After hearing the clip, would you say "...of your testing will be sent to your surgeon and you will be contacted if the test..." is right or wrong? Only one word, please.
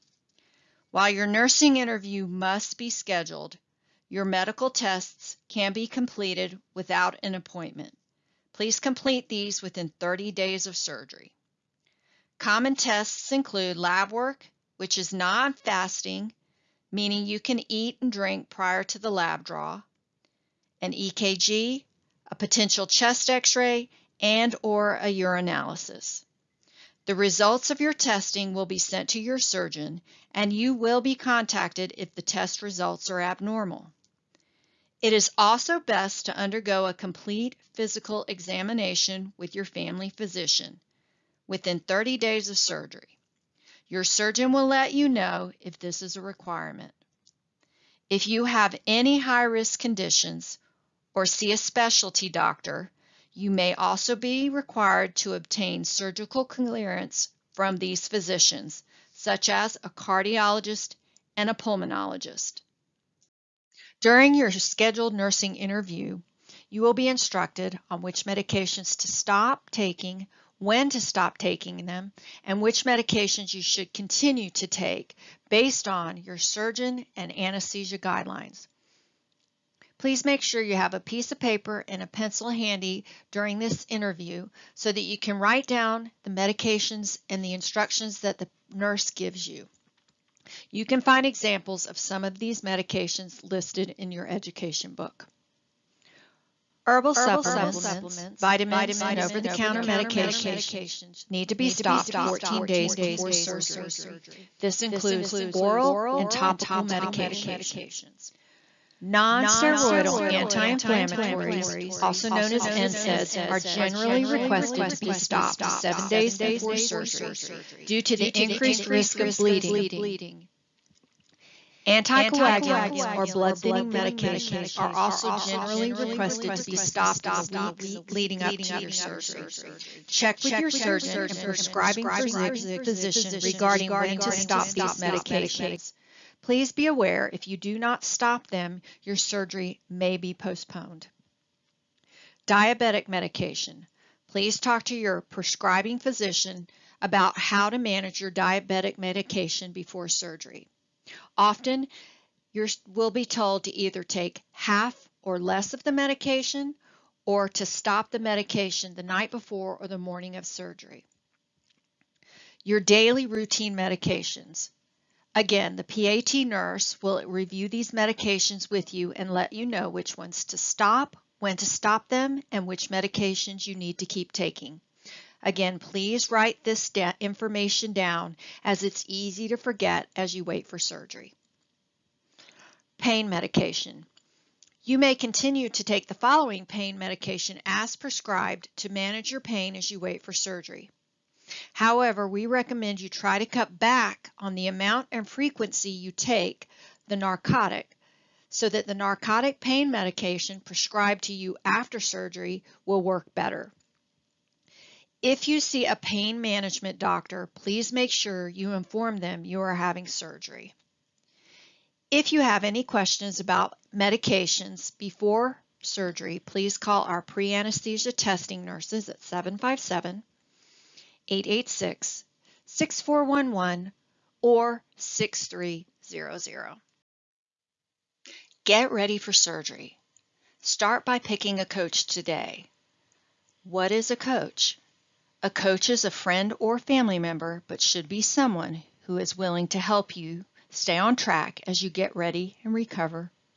right.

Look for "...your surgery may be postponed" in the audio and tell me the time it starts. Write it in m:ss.
2:19.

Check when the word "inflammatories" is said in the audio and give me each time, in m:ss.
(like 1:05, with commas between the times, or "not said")
1:50.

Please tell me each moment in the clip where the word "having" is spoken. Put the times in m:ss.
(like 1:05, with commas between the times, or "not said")
3:29.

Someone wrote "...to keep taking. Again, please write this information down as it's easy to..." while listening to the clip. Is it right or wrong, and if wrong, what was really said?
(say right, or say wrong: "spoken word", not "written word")
right.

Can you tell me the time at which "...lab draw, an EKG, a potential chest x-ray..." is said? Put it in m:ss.
0:19.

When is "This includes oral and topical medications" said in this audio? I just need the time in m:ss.
1:44.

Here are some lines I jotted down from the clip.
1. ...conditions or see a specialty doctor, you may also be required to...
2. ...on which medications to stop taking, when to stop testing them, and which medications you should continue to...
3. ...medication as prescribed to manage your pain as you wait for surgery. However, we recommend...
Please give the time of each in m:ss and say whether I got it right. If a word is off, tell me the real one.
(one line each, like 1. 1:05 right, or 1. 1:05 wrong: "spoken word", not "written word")
1. 0:49 right
2. 1:07 wrong: "taking", not "testing"
3. 3:06 right.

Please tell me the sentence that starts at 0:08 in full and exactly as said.
Please complete these within 30 days of surgery.